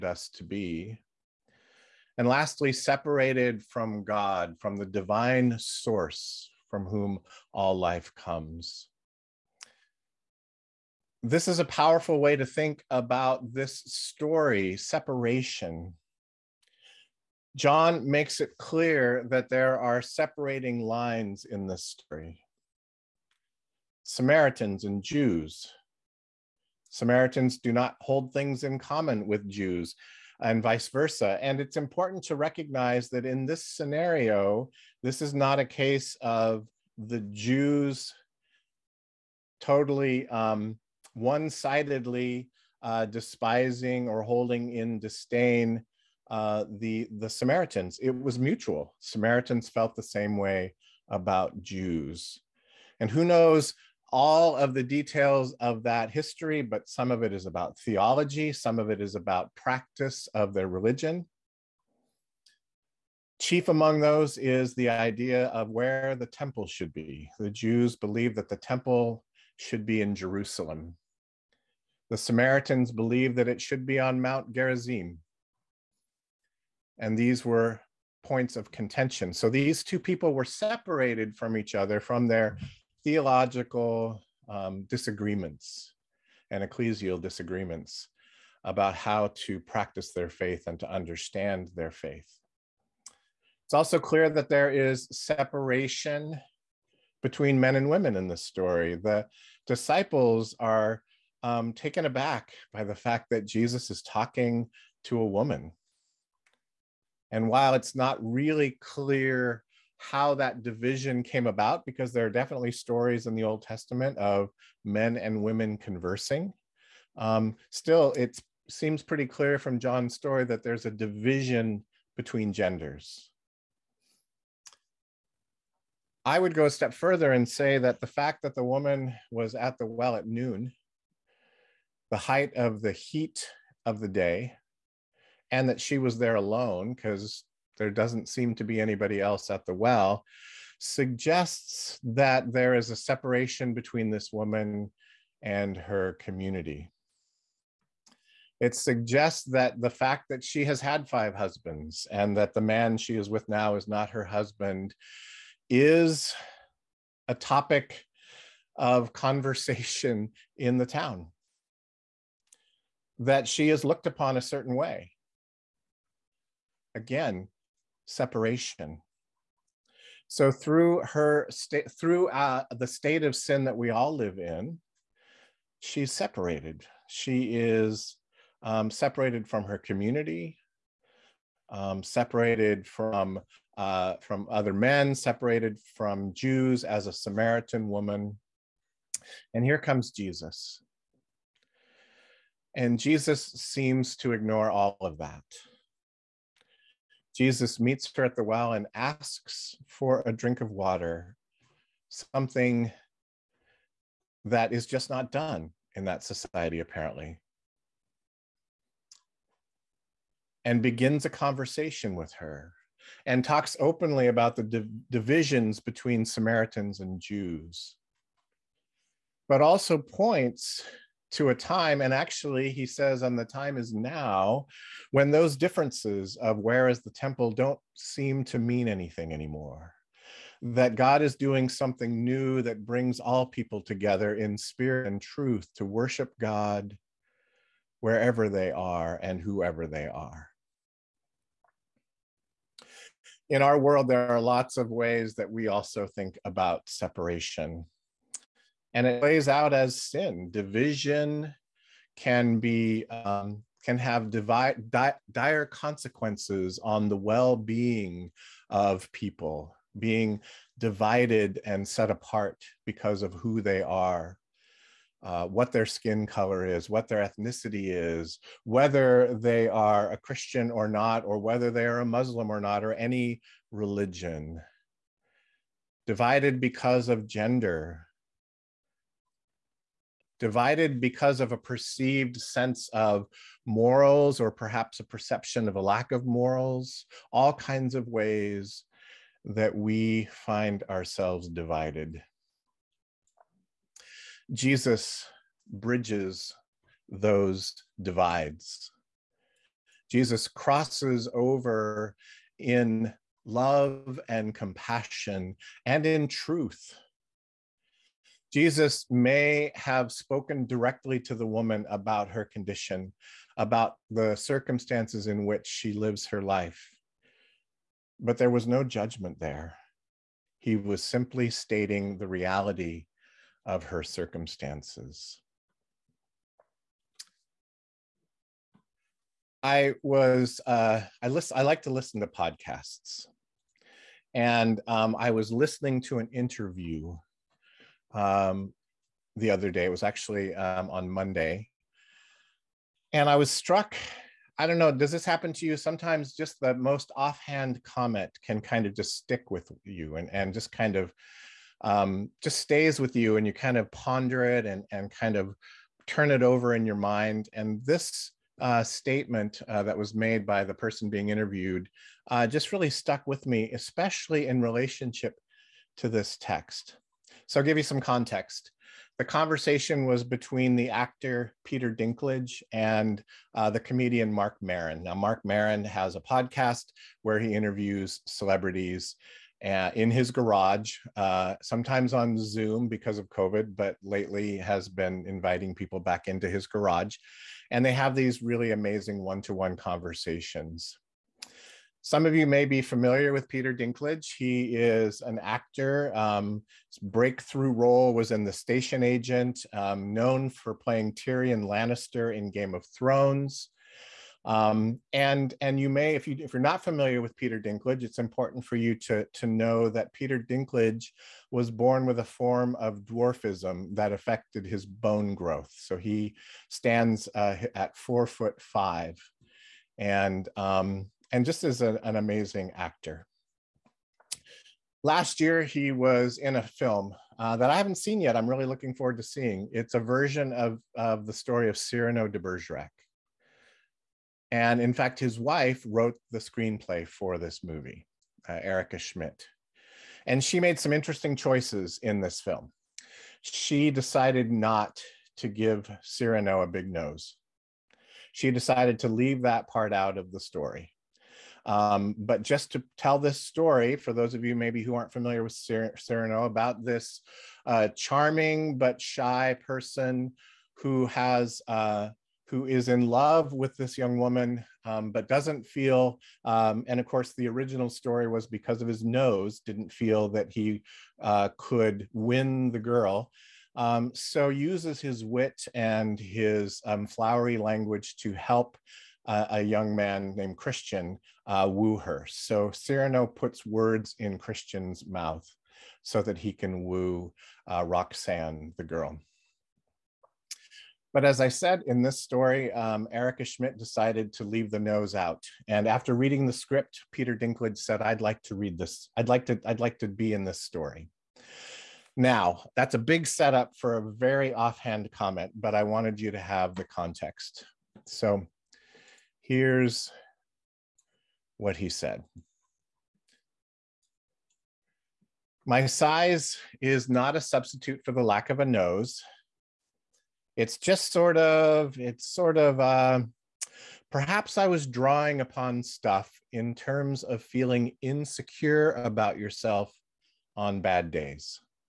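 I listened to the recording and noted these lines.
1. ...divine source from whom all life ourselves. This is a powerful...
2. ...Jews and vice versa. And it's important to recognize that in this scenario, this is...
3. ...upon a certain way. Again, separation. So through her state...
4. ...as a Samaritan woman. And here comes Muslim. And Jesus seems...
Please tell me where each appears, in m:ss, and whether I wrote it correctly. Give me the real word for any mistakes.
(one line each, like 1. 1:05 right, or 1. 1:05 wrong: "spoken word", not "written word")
1. 0:04 wrong: "comes", not "ourselves"
2. 0:29 right
3. 2:44 right
4. 3:06 wrong: "Jesus", not "Muslim".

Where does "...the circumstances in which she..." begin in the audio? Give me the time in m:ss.
5:14.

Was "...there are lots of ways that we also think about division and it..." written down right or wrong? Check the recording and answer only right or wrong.
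wrong.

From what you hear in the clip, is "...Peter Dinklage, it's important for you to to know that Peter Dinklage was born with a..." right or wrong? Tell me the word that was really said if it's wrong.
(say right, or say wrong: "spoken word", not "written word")
right.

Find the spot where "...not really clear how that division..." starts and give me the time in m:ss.
1:47.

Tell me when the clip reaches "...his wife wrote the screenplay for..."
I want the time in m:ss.
7:15.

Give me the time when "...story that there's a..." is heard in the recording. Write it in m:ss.
2:00.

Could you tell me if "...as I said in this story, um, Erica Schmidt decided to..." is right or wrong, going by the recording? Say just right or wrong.
right.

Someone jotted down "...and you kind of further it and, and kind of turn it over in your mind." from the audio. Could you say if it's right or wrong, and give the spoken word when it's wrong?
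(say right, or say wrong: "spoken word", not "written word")
wrong: "ponder", not "further".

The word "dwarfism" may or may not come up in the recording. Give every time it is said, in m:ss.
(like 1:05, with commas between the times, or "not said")
6:53.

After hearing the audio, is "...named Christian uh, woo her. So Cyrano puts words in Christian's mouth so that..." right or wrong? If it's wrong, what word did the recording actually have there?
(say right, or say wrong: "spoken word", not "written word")
right.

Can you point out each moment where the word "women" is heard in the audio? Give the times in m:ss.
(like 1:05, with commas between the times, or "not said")
1:37, 1:55.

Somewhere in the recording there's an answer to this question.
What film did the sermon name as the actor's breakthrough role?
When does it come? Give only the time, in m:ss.
6:38.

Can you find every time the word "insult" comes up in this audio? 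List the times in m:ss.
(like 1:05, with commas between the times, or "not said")
not said.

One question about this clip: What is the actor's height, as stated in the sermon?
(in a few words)
4 foot 5.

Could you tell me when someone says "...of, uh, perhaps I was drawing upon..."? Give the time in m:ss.
8:42.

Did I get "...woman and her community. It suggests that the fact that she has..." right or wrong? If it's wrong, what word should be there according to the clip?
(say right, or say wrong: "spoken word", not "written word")
right.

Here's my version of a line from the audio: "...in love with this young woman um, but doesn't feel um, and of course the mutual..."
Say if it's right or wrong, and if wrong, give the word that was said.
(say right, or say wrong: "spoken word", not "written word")
wrong: "original", not "mutual".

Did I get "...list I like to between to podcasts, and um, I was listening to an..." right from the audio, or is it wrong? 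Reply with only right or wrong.
wrong.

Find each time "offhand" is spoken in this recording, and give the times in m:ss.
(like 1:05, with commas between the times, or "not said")
5:47, 8:24.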